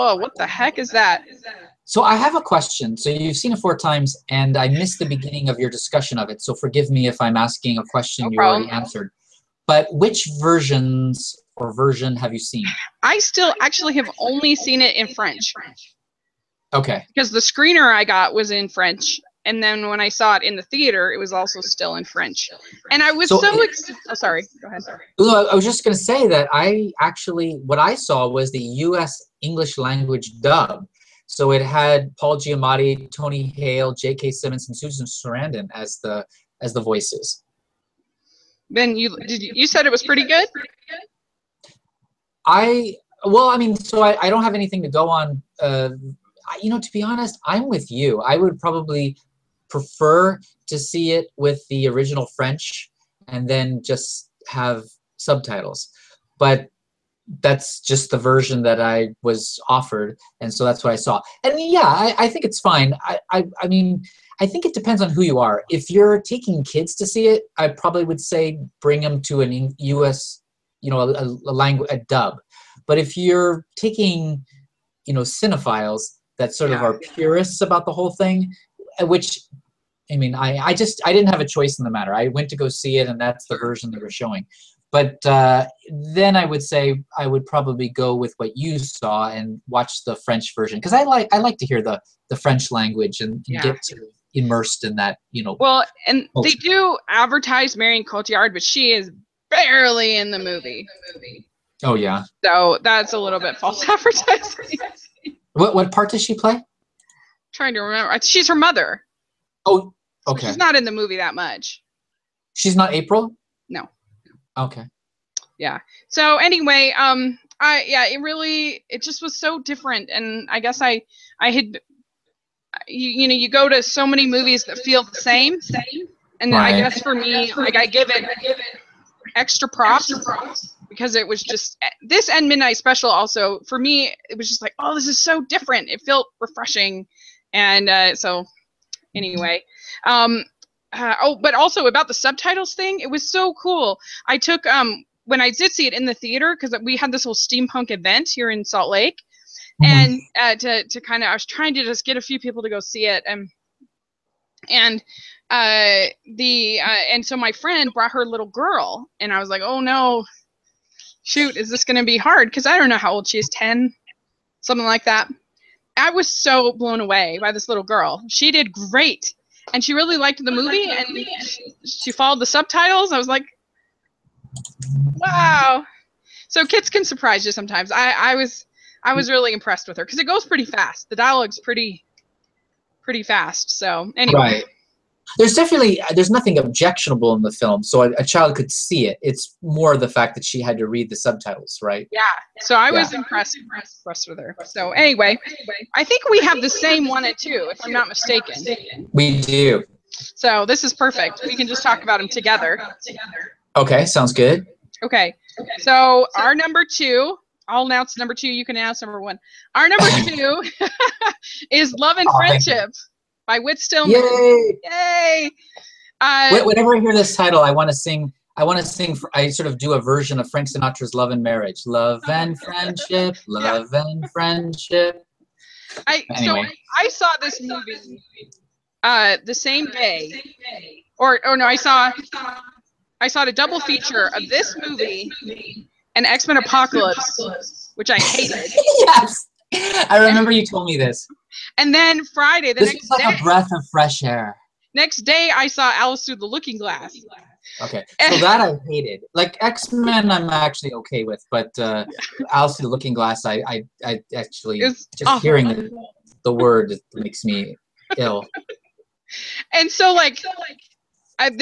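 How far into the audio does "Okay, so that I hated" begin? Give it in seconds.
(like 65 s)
247 s.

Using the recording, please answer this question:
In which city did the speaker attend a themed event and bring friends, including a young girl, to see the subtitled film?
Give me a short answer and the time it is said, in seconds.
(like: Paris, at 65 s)
Salt Lake, at 148 s.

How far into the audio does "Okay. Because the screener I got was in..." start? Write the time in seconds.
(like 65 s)
16 s.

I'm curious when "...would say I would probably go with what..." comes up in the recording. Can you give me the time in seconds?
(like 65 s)
86 s.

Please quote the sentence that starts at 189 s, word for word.
It's more the fact that she had to read the subtitles, right?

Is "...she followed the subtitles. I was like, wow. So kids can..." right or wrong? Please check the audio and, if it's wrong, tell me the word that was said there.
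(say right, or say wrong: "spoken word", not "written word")
right.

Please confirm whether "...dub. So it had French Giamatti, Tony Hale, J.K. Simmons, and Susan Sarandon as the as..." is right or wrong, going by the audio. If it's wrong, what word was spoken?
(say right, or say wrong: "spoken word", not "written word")
wrong: "Paul", not "French".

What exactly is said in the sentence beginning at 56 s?
But that's just the version that I was offered, and so that's what I saw.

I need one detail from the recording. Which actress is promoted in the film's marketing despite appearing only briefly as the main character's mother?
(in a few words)
Marion Cotillard.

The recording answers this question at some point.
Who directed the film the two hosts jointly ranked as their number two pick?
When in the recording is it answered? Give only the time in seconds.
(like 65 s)
213 s.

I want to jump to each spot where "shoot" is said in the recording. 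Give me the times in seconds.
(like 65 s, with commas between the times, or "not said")
161 s.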